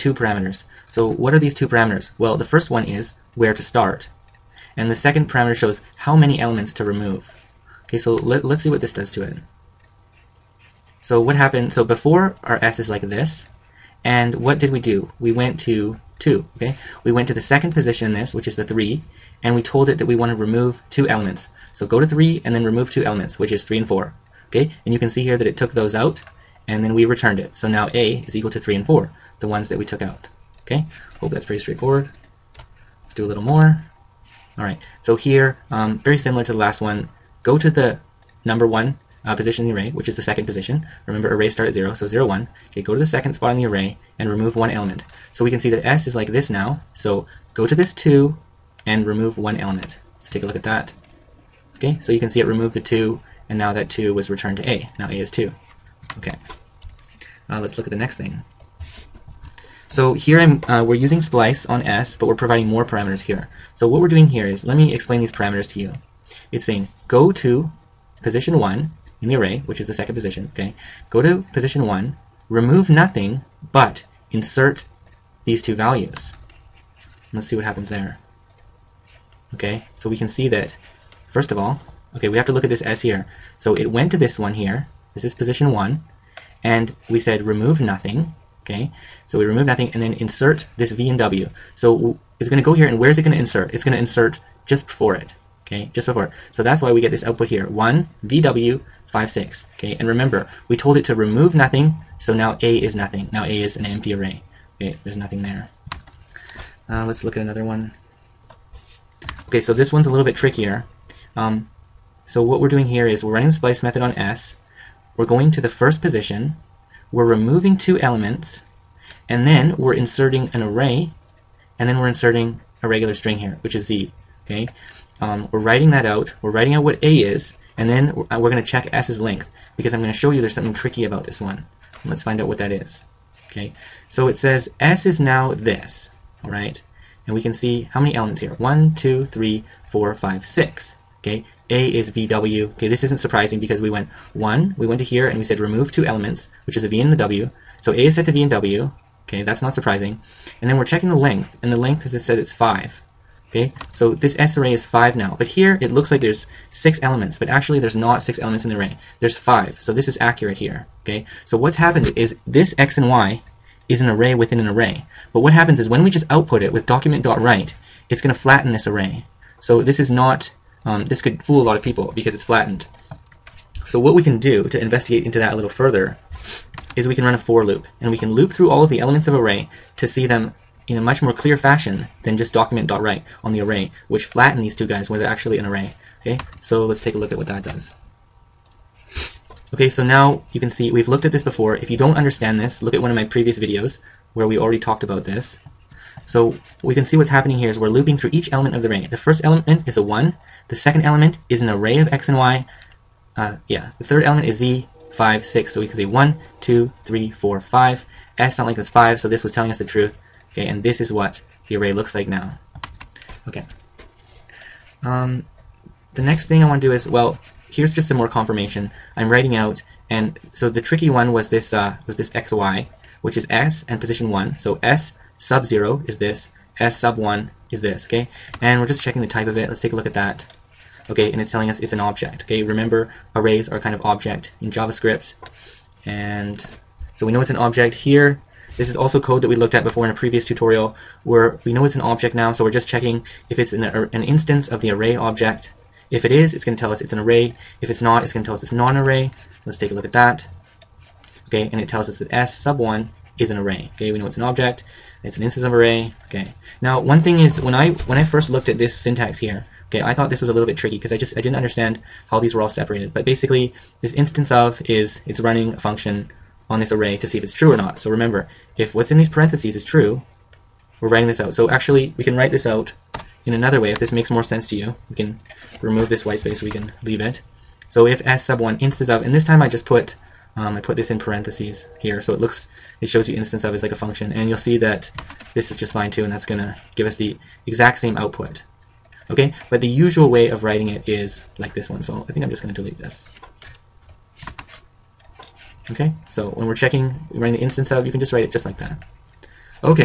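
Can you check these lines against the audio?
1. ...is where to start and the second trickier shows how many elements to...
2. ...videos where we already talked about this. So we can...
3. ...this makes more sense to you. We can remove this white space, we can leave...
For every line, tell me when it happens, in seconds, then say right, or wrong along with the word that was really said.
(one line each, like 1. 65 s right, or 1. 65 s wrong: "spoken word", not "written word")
1. 2 s wrong: "parameter", not "trickier"
2. 193 s right
3. 273 s right.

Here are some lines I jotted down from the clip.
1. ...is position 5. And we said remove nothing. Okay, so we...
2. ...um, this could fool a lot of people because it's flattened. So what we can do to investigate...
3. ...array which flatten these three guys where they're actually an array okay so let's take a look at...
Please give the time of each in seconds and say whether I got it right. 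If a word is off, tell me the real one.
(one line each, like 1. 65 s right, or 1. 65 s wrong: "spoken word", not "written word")
1. 85 s wrong: "1", not "5"
2. 170 s right
3. 183 s wrong: "two", not "three".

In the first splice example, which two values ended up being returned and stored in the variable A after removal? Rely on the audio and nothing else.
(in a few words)
3 and 4.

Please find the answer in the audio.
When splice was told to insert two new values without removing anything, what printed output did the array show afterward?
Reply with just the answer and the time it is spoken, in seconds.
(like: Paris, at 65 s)
1 VW 56, at 97 s.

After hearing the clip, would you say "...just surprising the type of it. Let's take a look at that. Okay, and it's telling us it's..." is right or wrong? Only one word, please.
wrong.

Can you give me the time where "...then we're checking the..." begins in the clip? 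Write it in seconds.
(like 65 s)
150 s.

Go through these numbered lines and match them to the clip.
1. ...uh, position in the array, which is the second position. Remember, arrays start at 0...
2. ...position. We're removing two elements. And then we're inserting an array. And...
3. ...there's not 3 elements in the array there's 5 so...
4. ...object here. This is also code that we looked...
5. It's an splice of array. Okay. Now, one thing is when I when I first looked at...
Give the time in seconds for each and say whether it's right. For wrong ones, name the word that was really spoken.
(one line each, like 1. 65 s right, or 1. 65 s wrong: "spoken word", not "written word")
1. 39 s right
2. 115 s right
3. 157 s wrong: "6", not "3"
4. 237 s right
5. 255 s wrong: "instance", not "splice".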